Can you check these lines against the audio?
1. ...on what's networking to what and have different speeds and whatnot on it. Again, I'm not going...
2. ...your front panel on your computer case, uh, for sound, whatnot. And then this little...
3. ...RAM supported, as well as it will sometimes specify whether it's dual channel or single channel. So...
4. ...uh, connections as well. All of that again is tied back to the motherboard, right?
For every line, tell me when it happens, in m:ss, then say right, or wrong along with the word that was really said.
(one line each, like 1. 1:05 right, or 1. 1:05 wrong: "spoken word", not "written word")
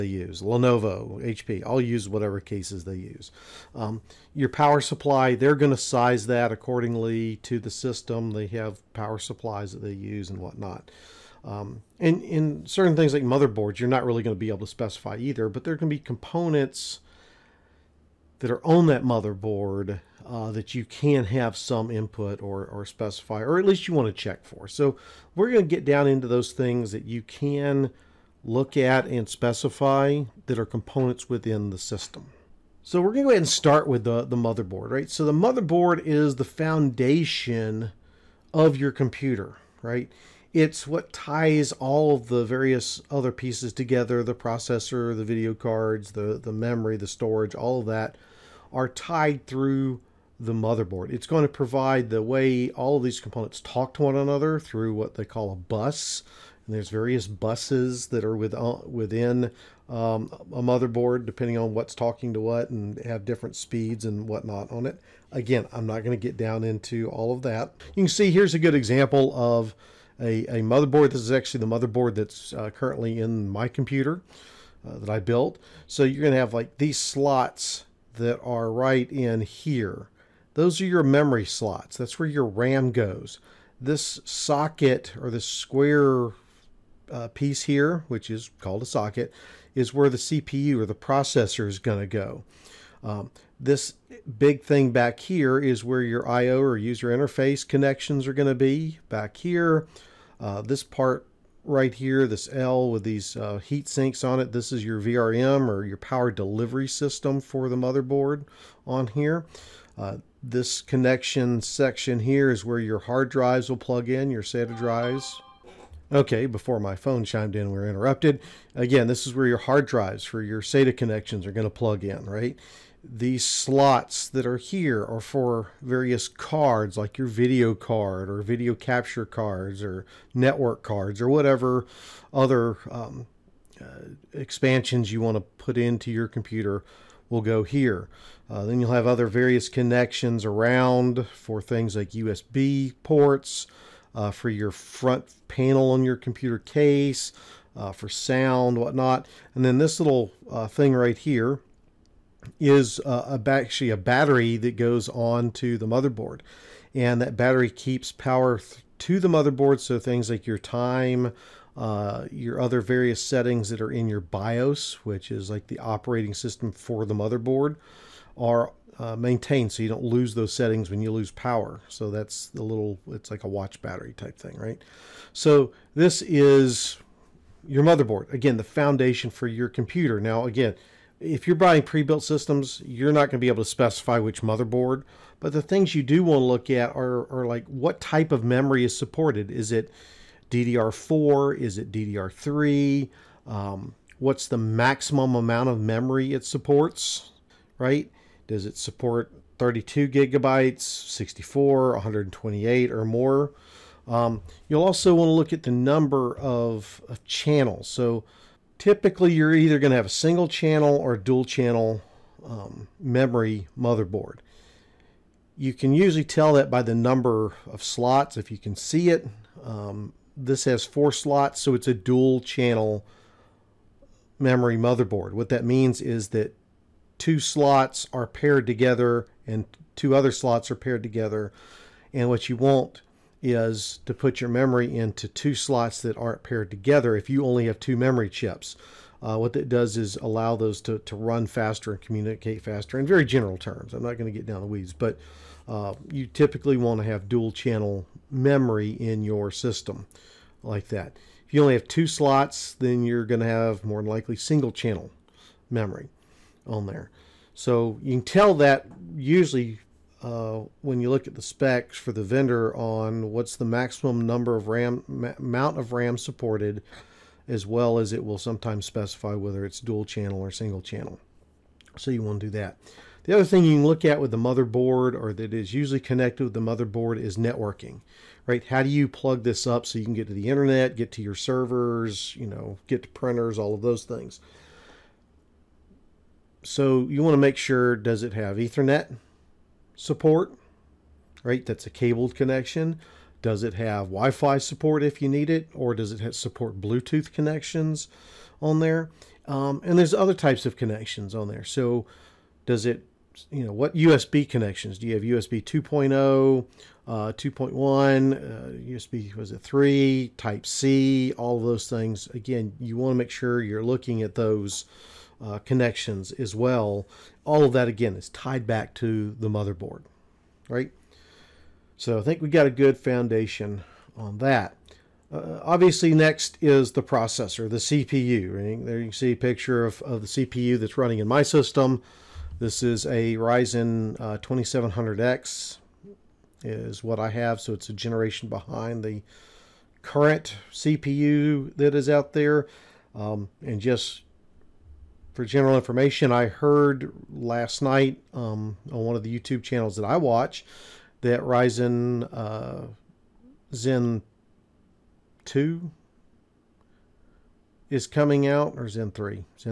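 1. 1:01 wrong: "talking", not "networking"
2. 2:24 right
3. 4:25 right
4. 5:15 right.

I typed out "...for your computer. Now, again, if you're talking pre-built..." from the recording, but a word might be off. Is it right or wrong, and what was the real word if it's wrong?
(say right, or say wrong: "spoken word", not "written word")
wrong: "buying", not "talking".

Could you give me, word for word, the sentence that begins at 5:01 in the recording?
So does it, you know, what USB connections?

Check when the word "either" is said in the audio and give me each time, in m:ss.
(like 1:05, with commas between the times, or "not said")
0:15, 3:29.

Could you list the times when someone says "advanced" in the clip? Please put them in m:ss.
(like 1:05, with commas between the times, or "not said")
not said.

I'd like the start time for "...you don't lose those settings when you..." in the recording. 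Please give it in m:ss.
2:49.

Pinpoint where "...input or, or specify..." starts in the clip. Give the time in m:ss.
0:21.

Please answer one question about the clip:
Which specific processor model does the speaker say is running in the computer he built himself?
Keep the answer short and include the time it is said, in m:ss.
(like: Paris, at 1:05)
Ryzen 2700X, at 5:33.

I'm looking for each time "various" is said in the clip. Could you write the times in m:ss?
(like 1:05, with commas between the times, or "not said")
0:42, 0:56, 2:05, 2:19, 2:42.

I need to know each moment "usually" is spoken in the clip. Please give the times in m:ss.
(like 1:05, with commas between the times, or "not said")
3:35, 4:19, 4:35.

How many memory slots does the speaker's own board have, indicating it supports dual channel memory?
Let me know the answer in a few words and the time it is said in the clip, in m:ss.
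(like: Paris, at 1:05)
4, at 3:40.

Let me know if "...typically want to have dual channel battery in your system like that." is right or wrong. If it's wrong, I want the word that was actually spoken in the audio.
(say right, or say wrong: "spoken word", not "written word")
wrong: "memory", not "battery".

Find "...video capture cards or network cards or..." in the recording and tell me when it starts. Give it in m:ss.
2:08.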